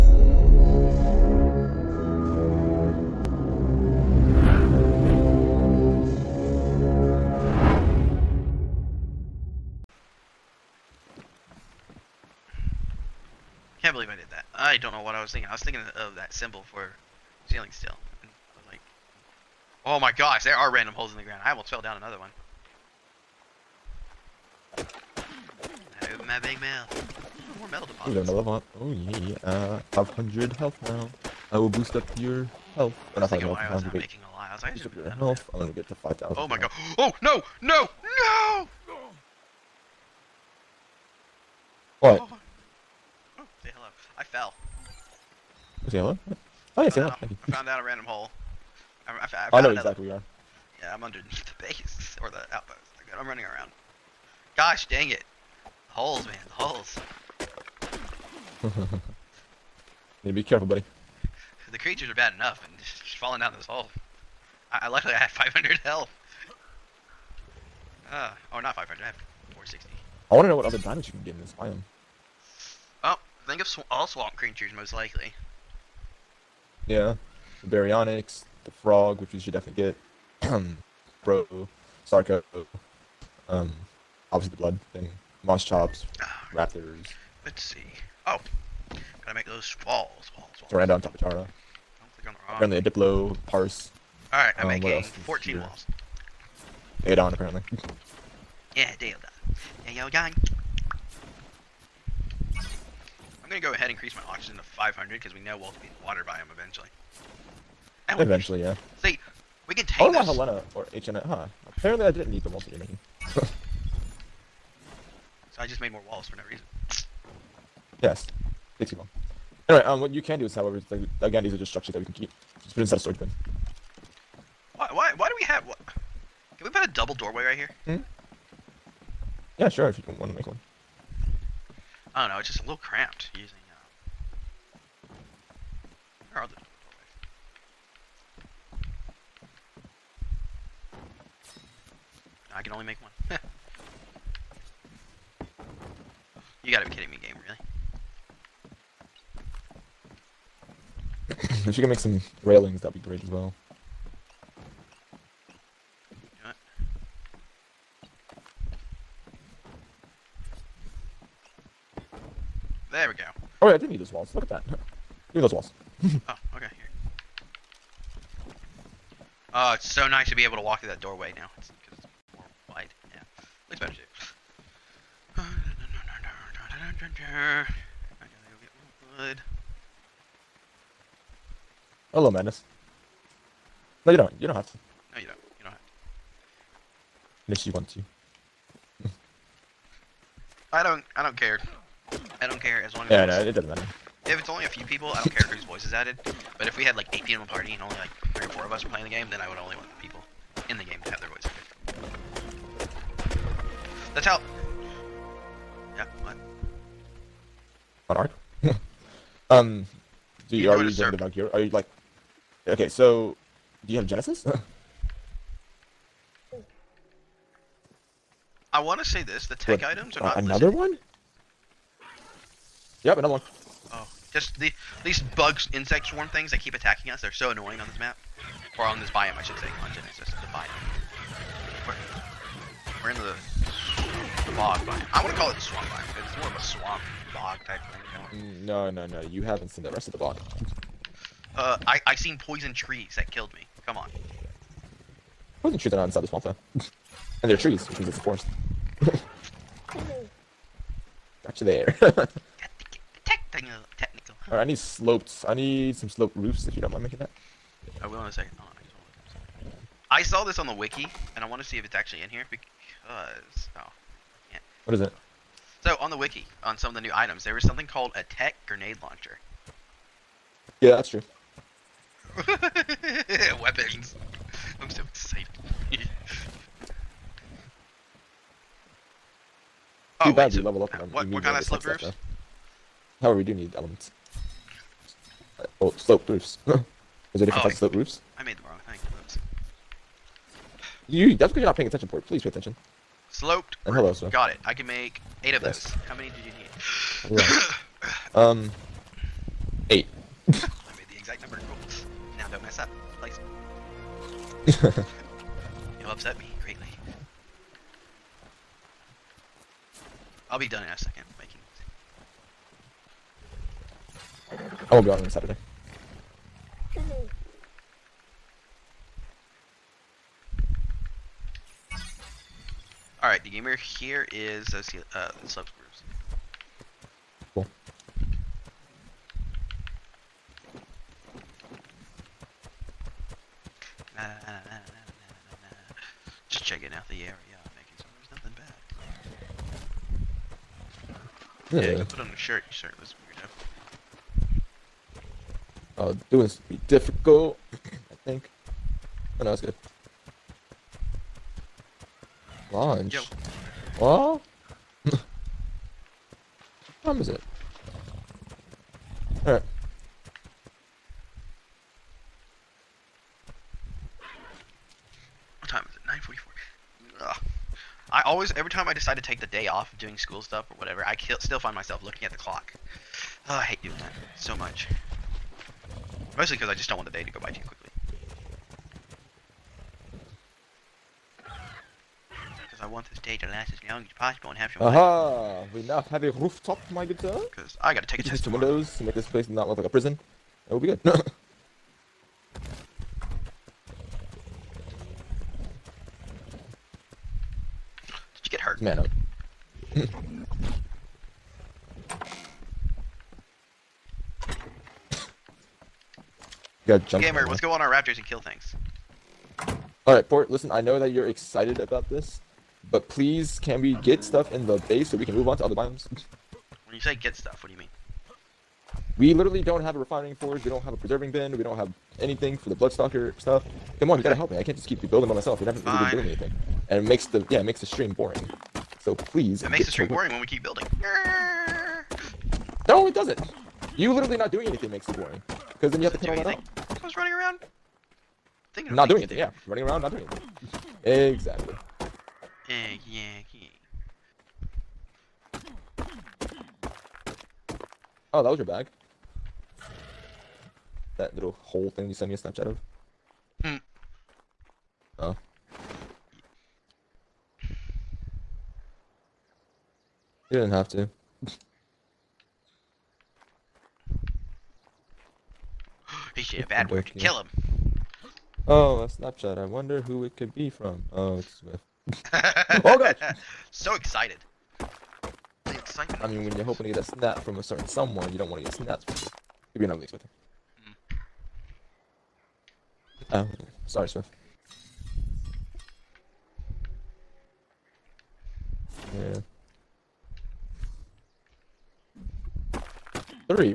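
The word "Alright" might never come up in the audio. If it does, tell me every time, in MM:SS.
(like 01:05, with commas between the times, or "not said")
01:34, 05:23, 06:50.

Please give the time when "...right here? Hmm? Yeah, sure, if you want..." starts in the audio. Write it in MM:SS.
02:07.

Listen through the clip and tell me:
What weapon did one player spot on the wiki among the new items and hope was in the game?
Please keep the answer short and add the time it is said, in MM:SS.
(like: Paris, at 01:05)
tech grenade launcher, at 04:28.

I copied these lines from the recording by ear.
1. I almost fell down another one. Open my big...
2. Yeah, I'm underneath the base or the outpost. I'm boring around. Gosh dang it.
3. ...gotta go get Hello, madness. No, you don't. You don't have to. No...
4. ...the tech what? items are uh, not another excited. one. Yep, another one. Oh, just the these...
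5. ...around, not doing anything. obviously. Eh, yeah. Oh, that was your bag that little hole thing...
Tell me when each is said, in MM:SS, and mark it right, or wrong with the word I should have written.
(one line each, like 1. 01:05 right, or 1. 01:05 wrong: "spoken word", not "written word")
1. 00:21 right
2. 00:50 wrong: "running", not "boring"
3. 02:58 right
4. 03:39 wrong: "listed", not "excited"
5. 07:19 wrong: "exactly", not "obviously".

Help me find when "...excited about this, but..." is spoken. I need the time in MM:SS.
06:51.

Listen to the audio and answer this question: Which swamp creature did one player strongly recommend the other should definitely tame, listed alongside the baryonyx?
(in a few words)
the frog.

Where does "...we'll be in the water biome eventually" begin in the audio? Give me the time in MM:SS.
01:45.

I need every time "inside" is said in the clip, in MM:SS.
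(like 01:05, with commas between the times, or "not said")
02:02, 04:06.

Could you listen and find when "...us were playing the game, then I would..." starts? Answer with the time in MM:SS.
03:18.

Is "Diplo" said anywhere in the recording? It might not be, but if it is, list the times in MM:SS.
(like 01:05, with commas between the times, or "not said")
01:32.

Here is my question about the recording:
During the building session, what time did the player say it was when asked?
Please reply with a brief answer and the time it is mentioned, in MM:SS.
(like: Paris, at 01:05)
9:44, at 06:06.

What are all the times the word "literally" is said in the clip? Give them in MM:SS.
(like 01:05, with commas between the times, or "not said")
06:59, 07:14.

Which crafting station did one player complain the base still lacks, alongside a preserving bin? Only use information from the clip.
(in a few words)
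refining forge.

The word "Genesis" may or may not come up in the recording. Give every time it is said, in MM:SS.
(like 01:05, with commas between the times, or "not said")
03:34, 03:49.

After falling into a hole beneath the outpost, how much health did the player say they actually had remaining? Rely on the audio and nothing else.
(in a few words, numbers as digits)
460.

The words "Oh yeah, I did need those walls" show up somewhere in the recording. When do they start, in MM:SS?
02:43.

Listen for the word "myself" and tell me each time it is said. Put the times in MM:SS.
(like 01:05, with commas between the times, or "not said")
06:11, 07:05.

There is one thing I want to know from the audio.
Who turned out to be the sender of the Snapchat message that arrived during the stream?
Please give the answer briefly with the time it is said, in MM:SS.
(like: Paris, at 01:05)
Swift, at 07:51.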